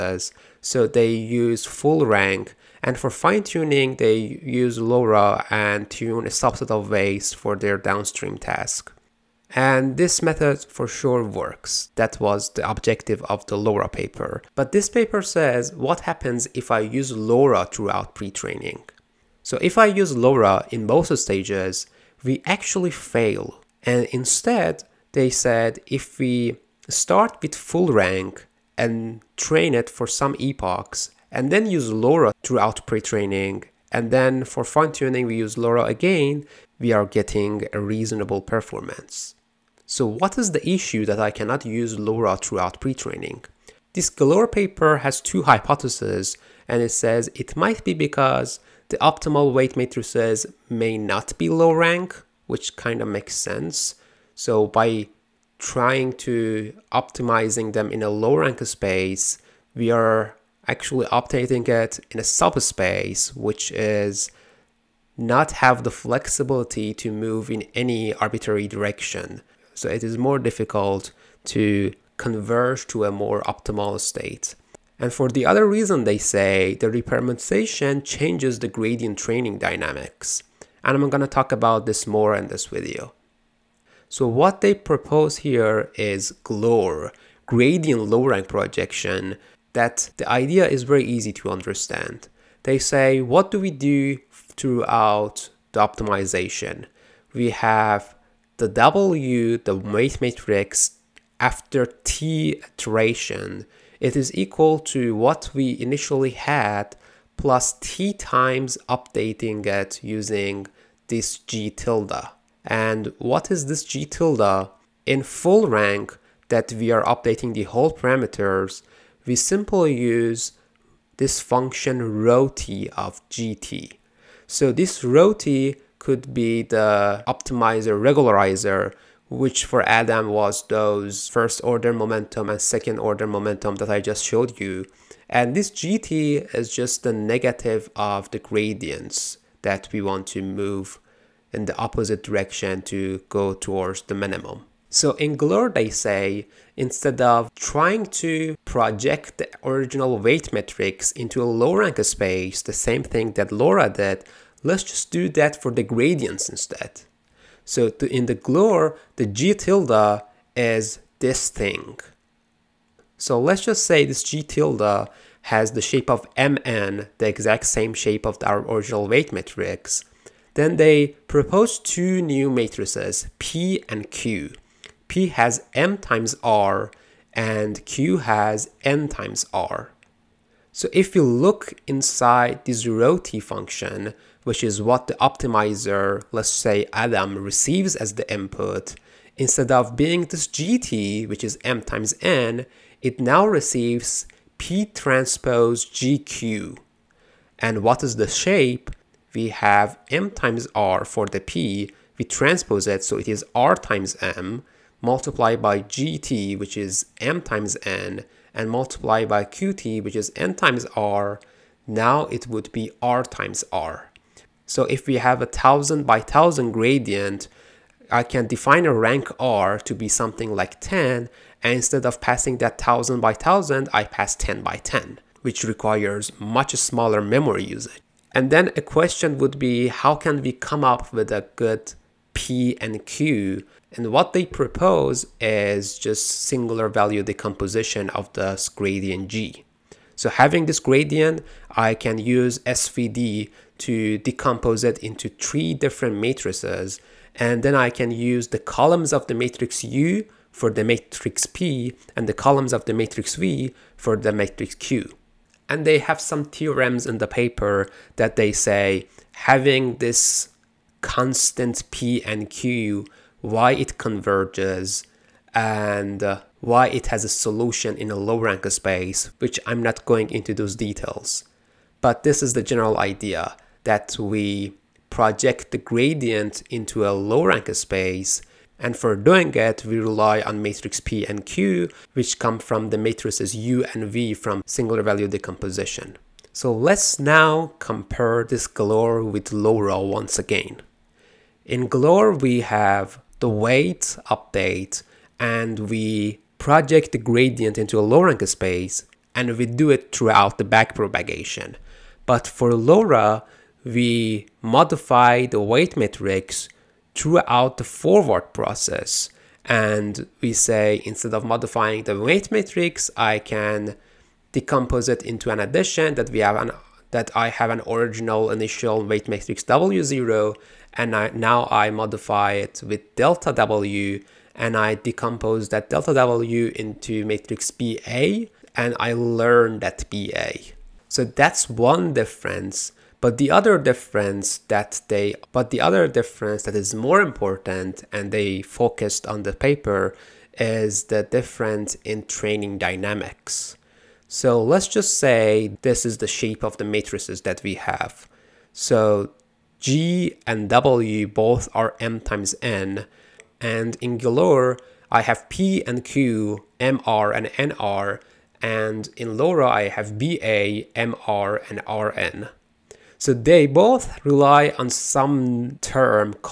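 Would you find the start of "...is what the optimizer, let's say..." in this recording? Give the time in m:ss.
3:04.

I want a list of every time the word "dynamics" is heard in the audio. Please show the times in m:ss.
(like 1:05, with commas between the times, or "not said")
1:19, 5:42.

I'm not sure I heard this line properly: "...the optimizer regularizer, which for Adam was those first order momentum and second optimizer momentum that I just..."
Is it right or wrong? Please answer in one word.
wrong.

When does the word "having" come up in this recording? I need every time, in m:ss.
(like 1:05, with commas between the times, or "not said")
4:00, 4:19.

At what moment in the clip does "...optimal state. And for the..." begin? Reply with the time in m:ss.
1:13.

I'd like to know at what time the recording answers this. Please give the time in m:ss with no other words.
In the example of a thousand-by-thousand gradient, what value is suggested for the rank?
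3:40.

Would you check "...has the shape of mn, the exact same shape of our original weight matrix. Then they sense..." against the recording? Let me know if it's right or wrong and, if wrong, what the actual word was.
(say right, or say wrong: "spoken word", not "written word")
wrong: "propose", not "sense".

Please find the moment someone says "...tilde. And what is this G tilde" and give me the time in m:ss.
1:51.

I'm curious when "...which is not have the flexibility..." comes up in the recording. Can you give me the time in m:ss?
1:03.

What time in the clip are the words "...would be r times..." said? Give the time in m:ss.
3:32.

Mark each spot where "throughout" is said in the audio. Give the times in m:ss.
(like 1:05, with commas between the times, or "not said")
0:17, 0:32, 0:42, 1:34, 5:00, 5:07.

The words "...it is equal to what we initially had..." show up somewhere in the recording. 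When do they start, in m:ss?
1:43.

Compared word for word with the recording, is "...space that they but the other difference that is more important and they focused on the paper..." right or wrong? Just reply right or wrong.
wrong.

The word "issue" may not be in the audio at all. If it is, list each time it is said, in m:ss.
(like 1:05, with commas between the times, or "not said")
0:40.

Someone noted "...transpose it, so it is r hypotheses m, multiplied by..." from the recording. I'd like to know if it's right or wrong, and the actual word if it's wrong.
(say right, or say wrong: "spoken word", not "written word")
wrong: "times", not "hypotheses".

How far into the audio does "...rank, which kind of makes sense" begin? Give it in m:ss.
0:51.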